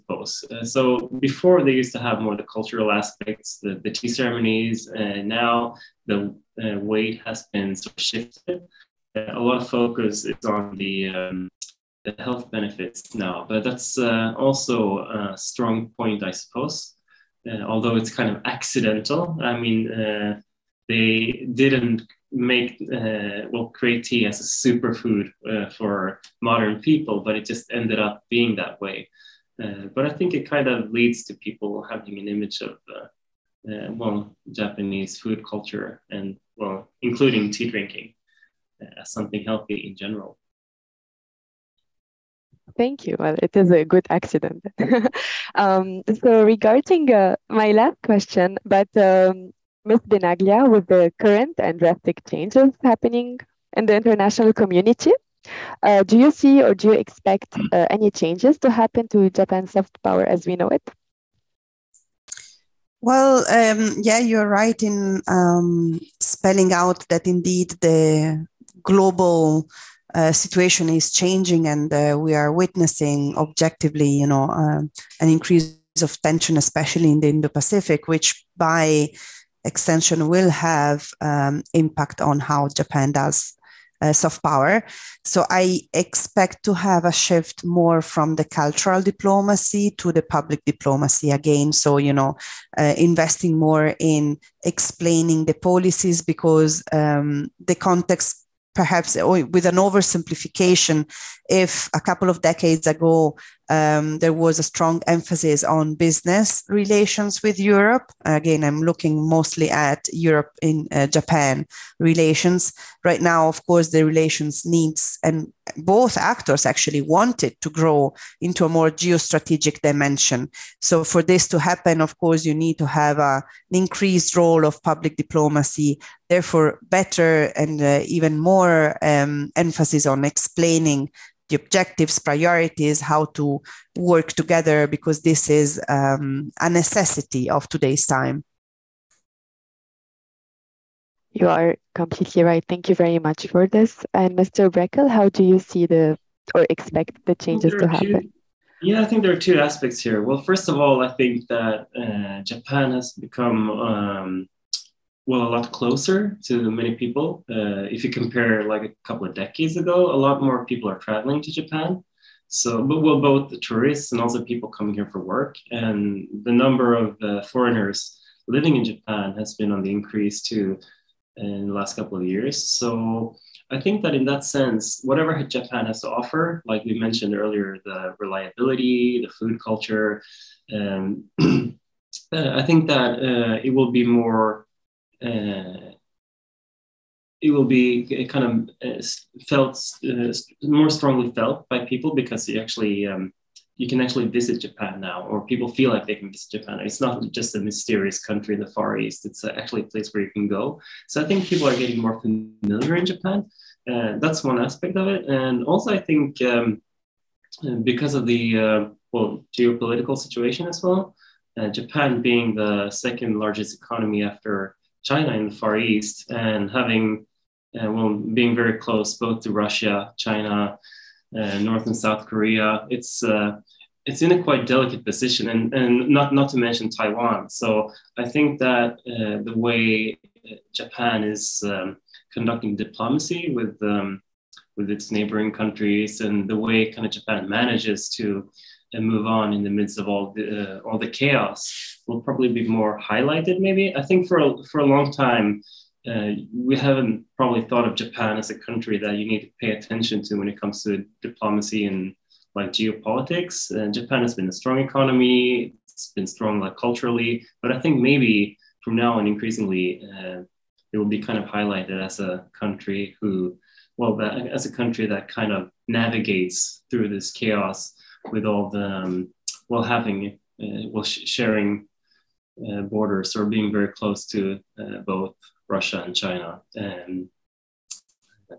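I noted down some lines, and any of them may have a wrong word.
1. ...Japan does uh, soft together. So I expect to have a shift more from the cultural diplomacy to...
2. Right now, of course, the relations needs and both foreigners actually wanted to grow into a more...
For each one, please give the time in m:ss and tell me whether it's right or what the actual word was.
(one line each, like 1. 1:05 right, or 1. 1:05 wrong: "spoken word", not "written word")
1. 1:22 wrong: "power", not "together"
2. 1:53 wrong: "actors", not "foreigners".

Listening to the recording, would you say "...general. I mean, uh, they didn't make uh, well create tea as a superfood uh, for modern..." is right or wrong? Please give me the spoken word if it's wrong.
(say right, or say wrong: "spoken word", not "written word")
wrong: "accidental", not "general".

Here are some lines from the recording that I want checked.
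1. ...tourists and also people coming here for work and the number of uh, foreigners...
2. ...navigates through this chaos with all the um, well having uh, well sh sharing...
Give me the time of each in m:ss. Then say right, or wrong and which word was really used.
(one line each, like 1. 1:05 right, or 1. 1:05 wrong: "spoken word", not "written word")
1. 2:43 right
2. 4:25 right.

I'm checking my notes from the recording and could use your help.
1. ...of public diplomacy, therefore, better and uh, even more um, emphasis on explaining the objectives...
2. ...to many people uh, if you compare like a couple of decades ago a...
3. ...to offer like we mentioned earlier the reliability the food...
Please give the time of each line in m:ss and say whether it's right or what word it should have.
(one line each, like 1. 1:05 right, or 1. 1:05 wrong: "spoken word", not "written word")
1. 2:04 right
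2. 2:36 right
3. 2:56 right.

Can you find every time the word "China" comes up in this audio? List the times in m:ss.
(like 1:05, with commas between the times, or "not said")
3:35, 3:40, 4:36.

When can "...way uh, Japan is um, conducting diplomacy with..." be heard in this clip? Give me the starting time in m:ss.
3:49.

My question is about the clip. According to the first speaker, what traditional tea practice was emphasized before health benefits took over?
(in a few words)
Tea ceremonies.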